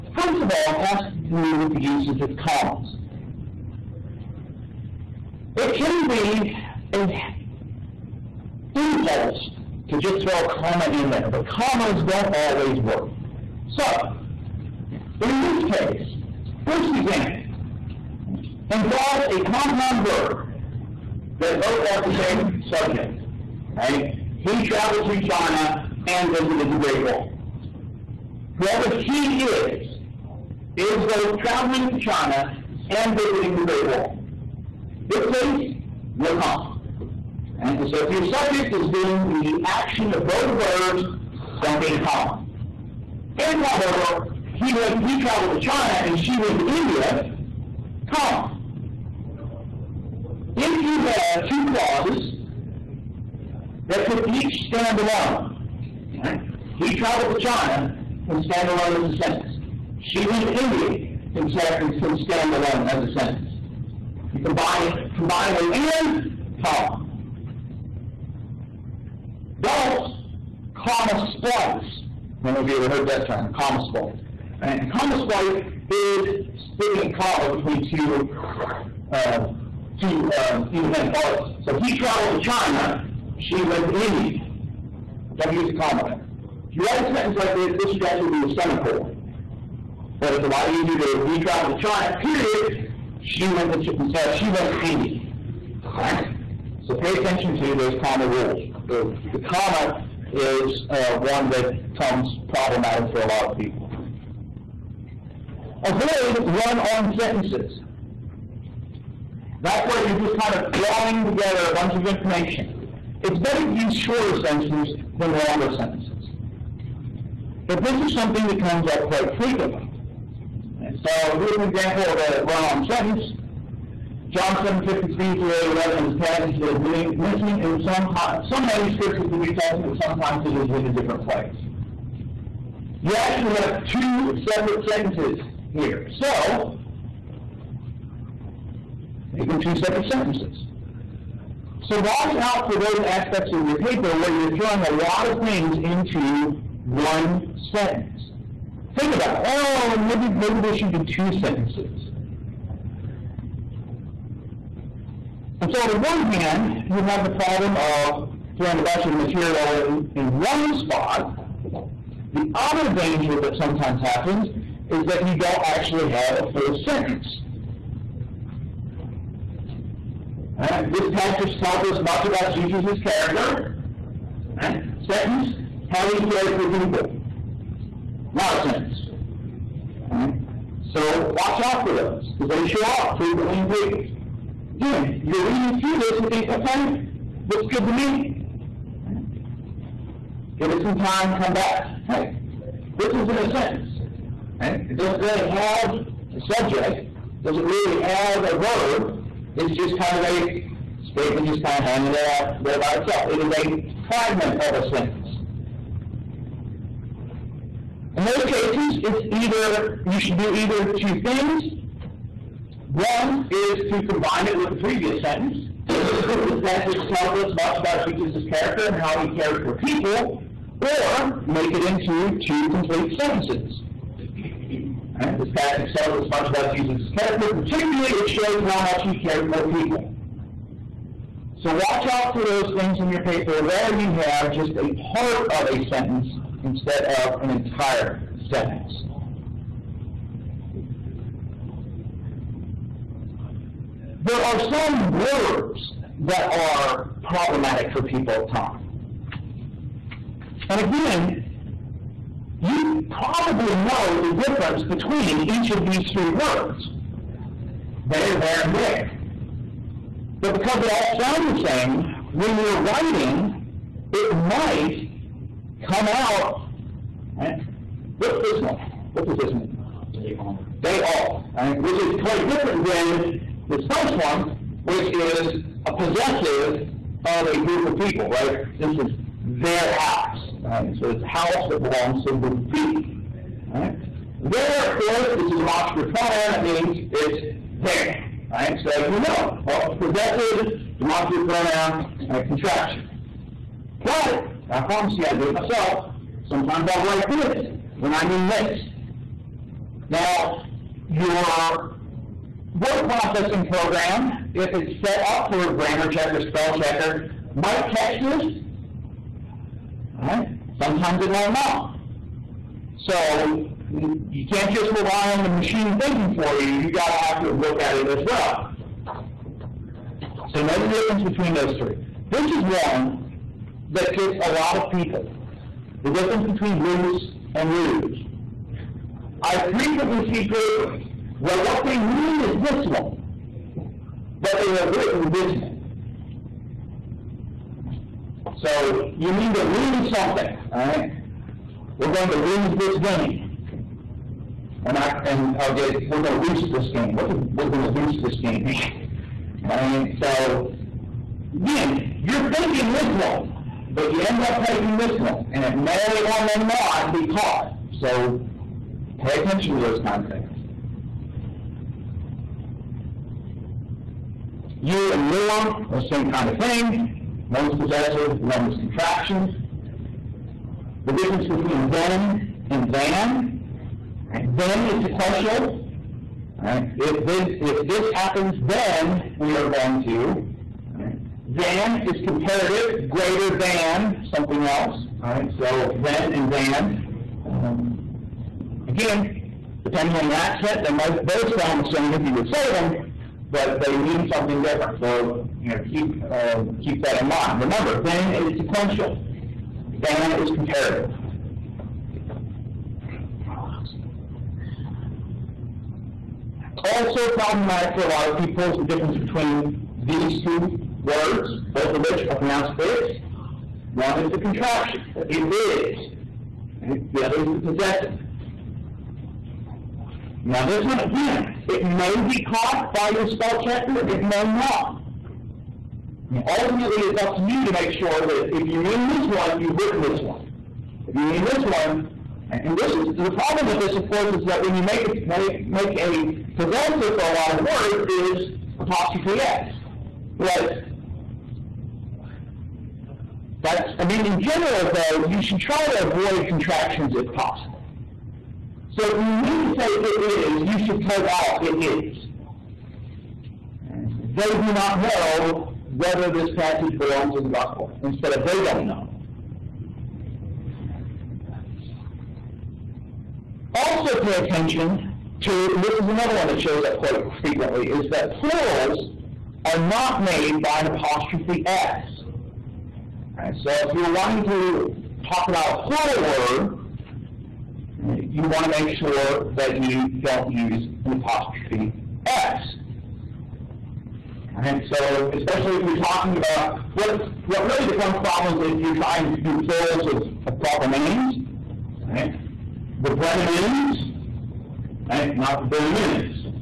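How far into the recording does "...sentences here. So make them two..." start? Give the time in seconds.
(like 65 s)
134 s.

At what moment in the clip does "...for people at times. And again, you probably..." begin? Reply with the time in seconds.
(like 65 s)
247 s.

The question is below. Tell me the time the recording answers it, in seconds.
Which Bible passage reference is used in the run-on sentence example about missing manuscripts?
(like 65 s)
124 s.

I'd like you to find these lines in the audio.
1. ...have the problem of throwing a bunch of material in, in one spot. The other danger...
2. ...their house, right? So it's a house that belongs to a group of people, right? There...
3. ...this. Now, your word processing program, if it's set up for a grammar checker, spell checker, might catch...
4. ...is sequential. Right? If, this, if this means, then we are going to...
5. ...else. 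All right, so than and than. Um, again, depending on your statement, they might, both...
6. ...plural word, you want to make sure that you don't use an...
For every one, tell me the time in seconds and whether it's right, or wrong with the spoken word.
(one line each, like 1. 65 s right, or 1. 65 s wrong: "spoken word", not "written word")
1. 157 s right
2. 279 s right
3. 298 s right
4. 374 s wrong: "happens", not "means"
5. 384 s wrong: "accent", not "statement"
6. 475 s right.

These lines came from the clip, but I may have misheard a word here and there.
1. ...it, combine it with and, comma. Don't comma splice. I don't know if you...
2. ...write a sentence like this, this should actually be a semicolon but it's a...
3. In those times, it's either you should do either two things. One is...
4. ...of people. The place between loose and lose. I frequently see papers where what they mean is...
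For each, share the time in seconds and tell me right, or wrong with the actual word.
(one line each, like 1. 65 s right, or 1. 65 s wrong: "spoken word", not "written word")
1. 64 s right
2. 86 s right
3. 208 s wrong: "cases", not "times"
4. 324 s wrong: "difference", not "place".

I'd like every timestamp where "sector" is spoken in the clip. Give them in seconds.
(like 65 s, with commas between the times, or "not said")
not said.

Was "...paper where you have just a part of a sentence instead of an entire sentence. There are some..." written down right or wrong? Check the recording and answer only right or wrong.
right.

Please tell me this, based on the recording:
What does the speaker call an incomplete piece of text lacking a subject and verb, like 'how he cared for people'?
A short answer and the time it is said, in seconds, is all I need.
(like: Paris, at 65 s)
a fragment, at 204 s.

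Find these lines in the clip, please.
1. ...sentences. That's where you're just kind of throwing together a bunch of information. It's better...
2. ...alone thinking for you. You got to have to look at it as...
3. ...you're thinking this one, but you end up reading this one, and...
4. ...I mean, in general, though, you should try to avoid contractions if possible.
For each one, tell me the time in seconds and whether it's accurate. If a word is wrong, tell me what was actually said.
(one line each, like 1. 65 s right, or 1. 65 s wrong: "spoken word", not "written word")
1. 107 s right
2. 315 s wrong: "machine", not "alone"
3. 352 s wrong: "taking", not "reading"
4. 443 s right.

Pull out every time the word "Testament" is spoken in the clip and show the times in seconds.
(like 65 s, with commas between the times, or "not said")
129 s.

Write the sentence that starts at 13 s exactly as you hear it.
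So, in this case, first example involves a compound verb that both have the same subject, right?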